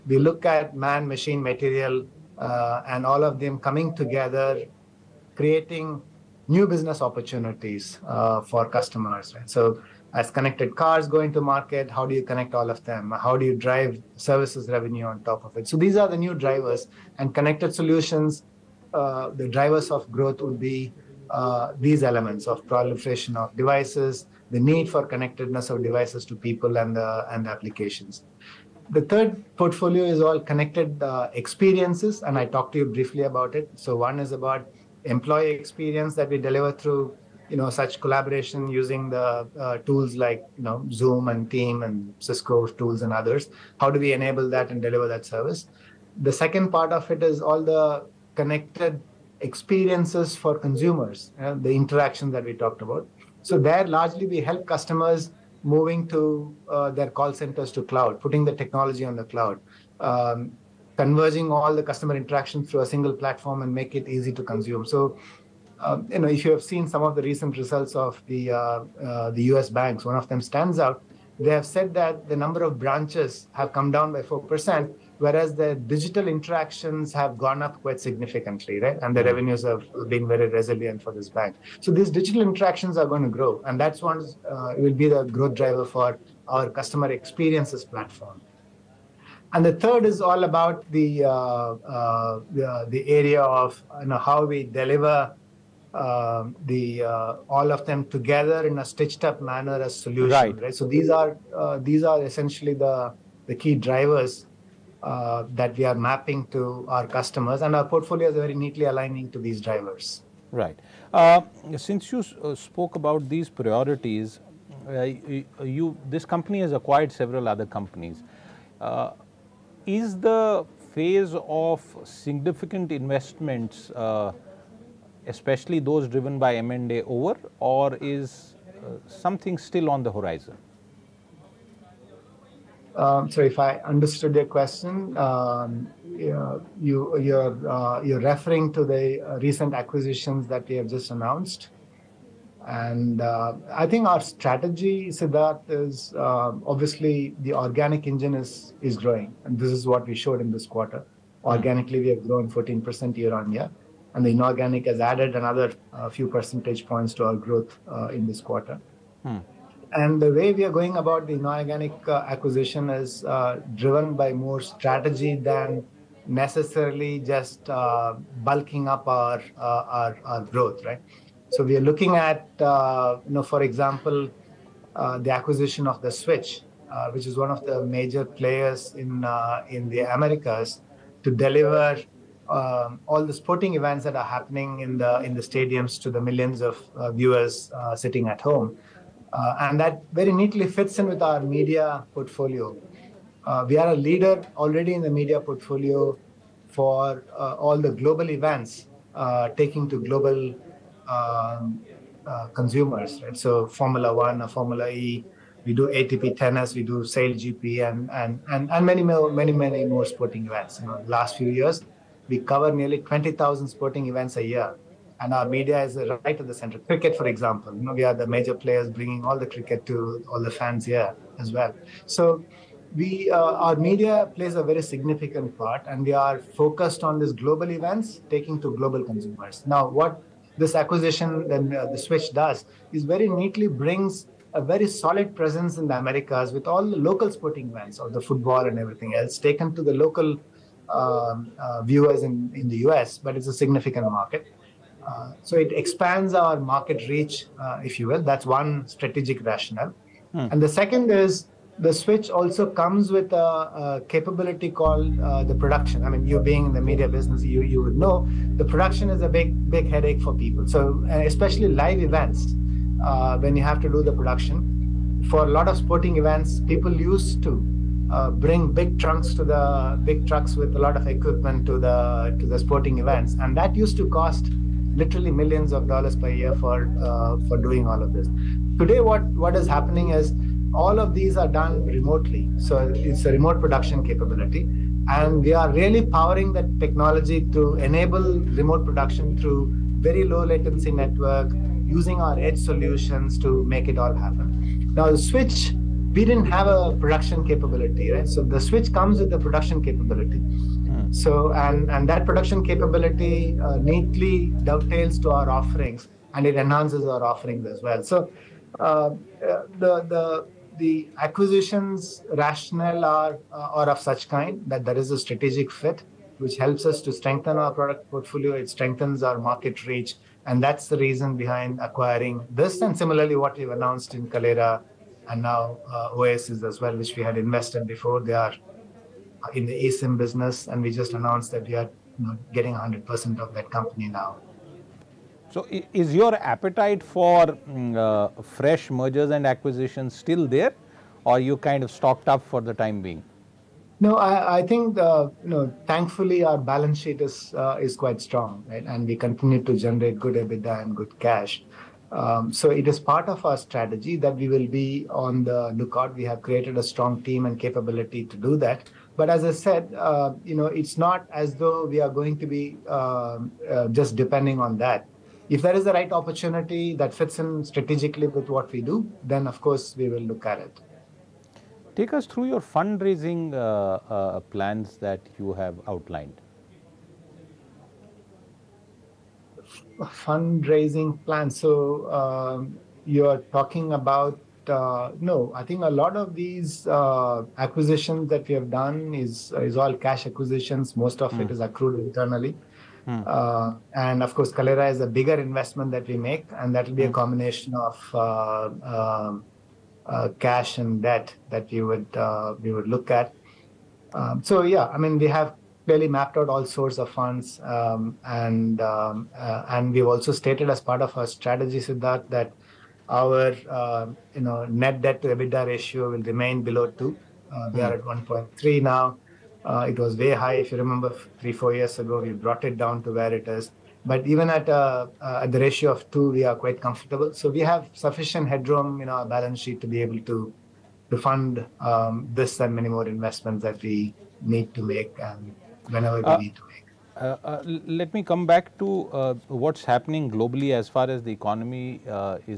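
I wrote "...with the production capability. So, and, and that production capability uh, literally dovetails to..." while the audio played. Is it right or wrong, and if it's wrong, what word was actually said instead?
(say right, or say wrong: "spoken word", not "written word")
wrong: "neatly", not "literally".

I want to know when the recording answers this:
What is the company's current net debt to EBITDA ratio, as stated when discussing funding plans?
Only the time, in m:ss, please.
6:58.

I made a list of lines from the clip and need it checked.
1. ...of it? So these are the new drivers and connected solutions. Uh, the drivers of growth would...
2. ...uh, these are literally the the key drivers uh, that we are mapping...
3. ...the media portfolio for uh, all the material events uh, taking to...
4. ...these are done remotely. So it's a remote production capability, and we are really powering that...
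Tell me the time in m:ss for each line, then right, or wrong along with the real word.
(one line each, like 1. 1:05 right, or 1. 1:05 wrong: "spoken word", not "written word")
1. 0:15 right
2. 1:41 wrong: "essentially", not "literally"
3. 3:15 wrong: "global", not "material"
4. 4:41 right.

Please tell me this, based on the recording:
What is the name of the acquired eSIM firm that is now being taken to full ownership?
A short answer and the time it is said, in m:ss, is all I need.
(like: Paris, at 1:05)
Oasis, at 5:26.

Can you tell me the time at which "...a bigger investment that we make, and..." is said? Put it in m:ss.
6:35.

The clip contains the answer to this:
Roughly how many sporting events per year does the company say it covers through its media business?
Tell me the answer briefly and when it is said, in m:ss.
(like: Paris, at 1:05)
20,000, at 3:32.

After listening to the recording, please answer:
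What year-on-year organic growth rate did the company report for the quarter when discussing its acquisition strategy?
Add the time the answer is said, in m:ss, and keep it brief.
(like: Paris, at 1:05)
14%, at 2:32.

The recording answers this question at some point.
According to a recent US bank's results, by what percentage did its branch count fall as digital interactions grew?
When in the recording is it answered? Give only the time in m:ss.
1:14.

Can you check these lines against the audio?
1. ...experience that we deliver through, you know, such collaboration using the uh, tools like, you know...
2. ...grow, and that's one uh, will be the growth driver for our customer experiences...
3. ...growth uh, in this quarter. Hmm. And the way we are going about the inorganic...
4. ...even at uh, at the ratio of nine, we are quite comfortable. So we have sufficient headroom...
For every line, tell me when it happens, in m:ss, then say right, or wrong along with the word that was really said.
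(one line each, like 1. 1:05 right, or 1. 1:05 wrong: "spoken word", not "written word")
1. 0:35 right
2. 1:23 right
3. 2:37 right
4. 7:04 wrong: "two", not "nine".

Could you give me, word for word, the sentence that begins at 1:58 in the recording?
Uh, is the phase of significant investments, uh, especially those driven by M&A, over, or is something still on the horizon?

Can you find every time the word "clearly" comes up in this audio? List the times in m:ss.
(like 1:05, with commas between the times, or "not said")
6:45.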